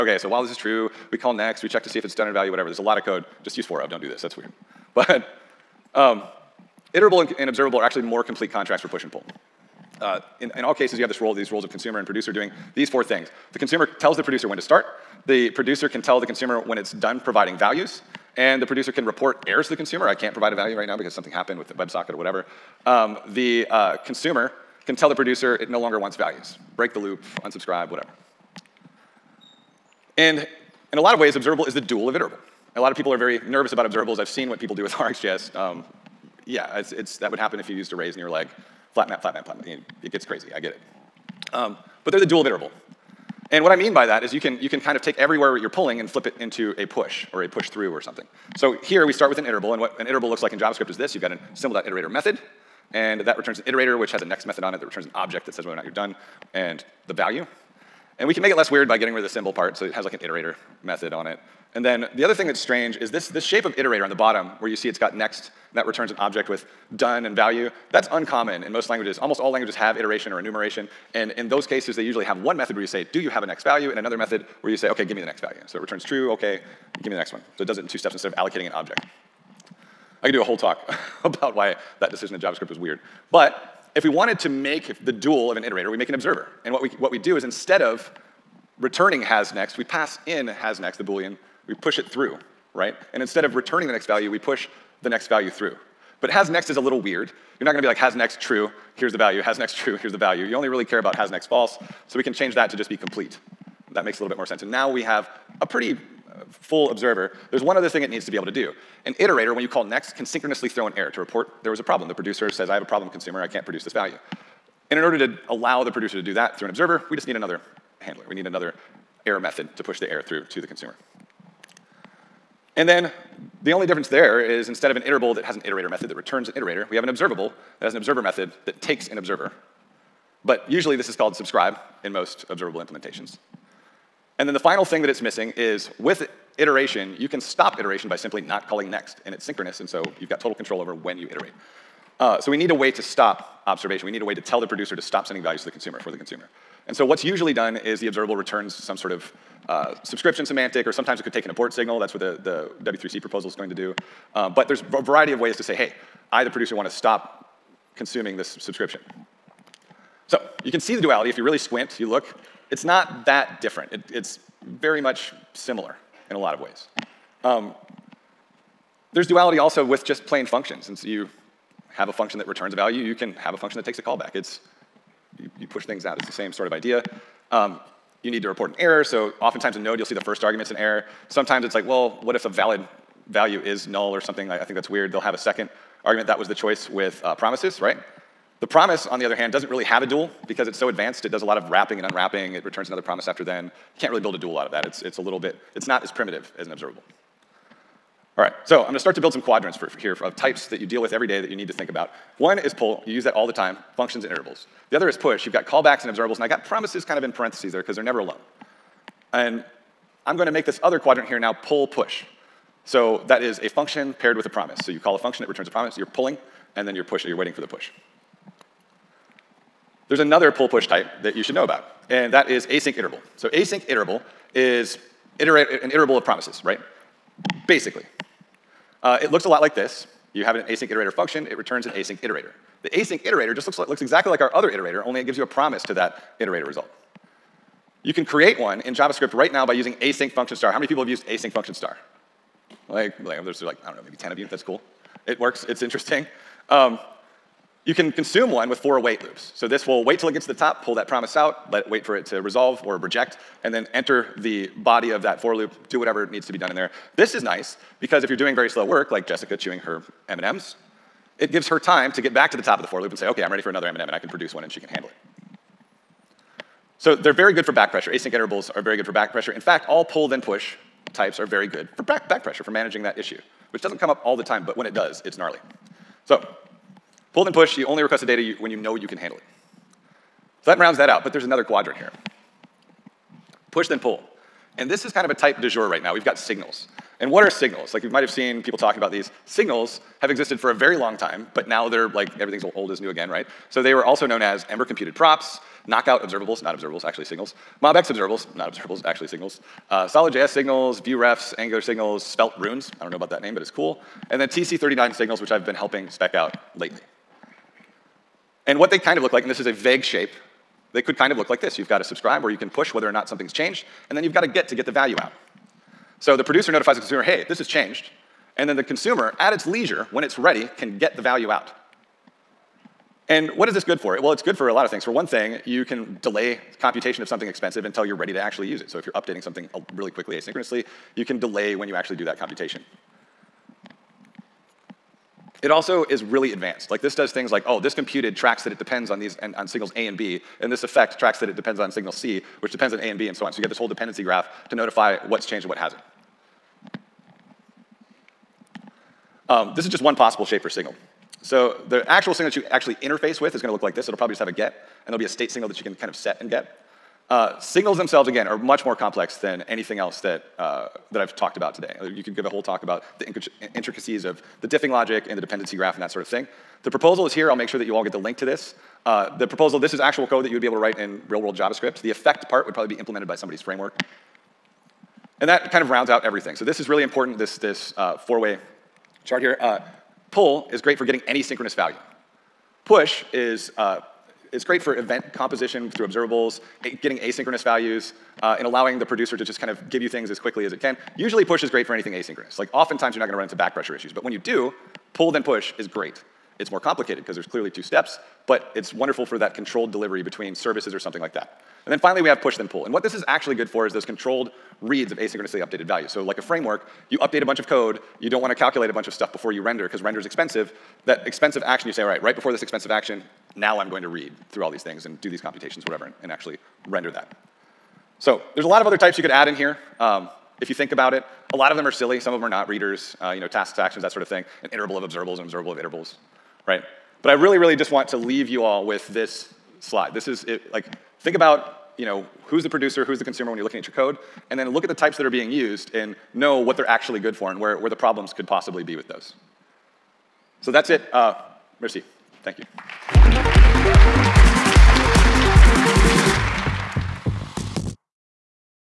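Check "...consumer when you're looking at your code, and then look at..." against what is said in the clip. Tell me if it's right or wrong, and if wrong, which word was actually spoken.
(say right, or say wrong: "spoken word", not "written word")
right.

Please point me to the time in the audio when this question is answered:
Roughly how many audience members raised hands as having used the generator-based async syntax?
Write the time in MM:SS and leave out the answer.
04:04.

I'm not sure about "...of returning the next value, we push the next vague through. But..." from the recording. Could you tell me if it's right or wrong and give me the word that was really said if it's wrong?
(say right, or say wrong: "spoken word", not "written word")
wrong: "value", not "vague".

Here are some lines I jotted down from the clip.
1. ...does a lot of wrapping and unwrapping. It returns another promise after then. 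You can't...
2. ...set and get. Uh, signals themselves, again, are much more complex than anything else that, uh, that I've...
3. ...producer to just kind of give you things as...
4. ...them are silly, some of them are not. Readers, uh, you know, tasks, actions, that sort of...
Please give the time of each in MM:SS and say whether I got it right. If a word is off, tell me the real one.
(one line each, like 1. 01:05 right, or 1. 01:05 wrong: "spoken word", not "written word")
1. 03:11 right
2. 05:56 right
3. 06:29 right
4. 07:01 right.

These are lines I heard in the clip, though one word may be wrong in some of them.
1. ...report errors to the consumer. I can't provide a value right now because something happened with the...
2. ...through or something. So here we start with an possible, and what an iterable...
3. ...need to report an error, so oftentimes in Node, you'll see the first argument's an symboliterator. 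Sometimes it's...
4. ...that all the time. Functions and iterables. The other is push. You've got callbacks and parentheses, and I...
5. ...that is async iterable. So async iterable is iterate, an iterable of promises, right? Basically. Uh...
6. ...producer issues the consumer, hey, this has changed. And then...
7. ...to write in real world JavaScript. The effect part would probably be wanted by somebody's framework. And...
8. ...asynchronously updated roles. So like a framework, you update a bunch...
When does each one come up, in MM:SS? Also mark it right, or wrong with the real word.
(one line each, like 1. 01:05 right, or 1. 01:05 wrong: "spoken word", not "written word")
1. 00:19 right
2. 00:47 wrong: "iterable", not "possible"
3. 02:58 wrong: "error", not "symboliterator"
4. 03:23 wrong: "observables", not "parentheses"
5. 03:42 right
6. 05:16 wrong: "notifies", not "issues"
7. 06:10 wrong: "implemented", not "wanted"
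8. 06:45 wrong: "values", not "roles".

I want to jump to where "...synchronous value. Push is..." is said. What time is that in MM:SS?
06:21.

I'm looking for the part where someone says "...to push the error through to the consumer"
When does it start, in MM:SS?
01:59.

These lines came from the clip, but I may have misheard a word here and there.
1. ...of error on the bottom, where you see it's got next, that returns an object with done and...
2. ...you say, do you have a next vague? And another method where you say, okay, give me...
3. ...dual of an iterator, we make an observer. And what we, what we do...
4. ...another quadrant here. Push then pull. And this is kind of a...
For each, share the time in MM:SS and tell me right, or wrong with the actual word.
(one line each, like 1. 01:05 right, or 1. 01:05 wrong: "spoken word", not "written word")
1. 01:03 wrong: "iterator", not "error"
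2. 01:12 wrong: "value", not "vague"
3. 01:25 right
4. 04:41 right.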